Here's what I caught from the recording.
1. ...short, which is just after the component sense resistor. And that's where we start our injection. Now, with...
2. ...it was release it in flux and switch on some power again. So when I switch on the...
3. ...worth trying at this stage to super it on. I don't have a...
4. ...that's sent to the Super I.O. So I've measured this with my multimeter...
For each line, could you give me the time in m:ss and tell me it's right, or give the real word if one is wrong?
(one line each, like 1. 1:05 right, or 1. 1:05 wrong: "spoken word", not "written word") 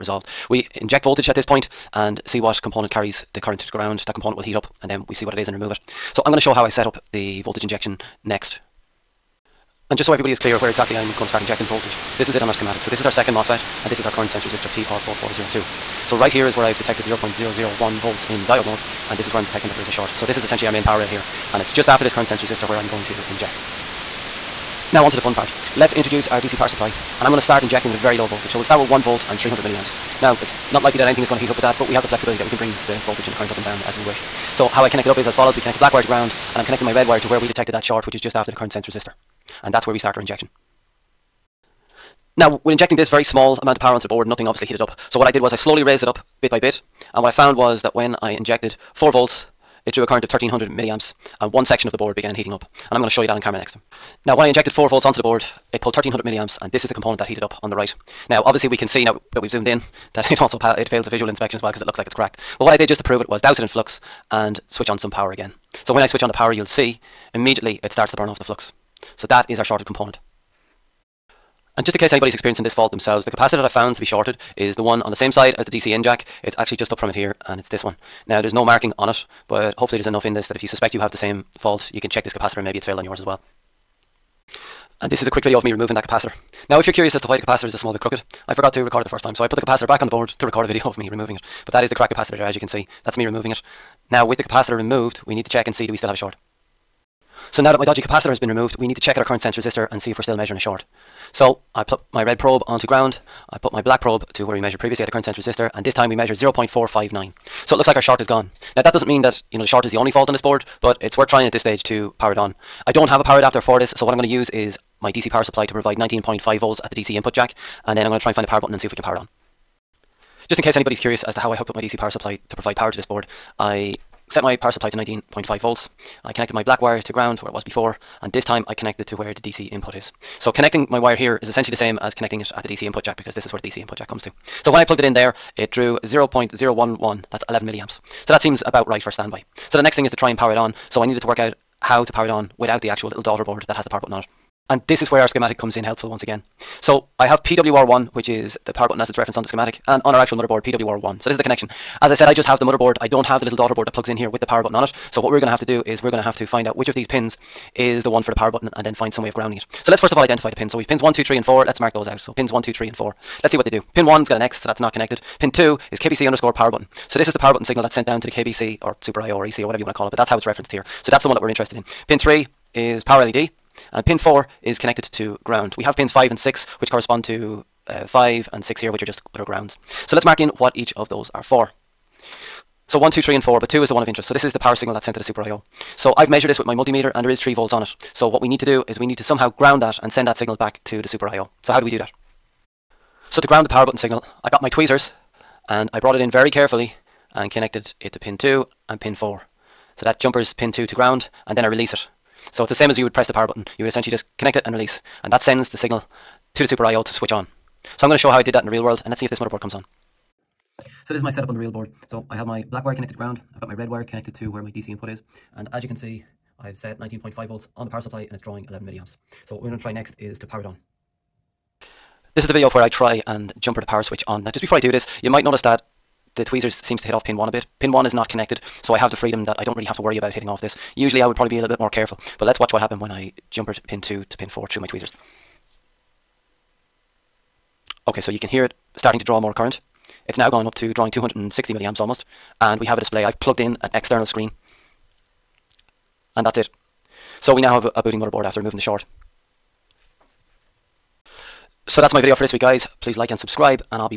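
1. 0:37 wrong: "current", not "component"
2. 1:03 wrong: "douse", not "release"
3. 1:51 wrong: "power", not "super"
4. 3:04 right.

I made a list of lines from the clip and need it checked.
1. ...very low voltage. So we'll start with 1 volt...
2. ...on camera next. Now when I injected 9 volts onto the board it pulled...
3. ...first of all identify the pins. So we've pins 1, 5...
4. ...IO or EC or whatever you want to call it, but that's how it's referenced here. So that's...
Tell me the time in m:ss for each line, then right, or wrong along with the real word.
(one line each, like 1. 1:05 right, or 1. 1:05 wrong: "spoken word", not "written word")
1. 0:27 right
2. 0:53 wrong: "4", not "9"
3. 2:39 wrong: "2", not "5"
4. 2:49 right.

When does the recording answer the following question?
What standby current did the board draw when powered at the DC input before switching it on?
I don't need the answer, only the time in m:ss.
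2:17.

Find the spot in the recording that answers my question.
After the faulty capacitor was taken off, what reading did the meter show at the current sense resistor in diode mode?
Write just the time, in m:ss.
1:46.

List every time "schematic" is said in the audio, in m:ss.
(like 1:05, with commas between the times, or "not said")
0:12, 2:25, 2:29.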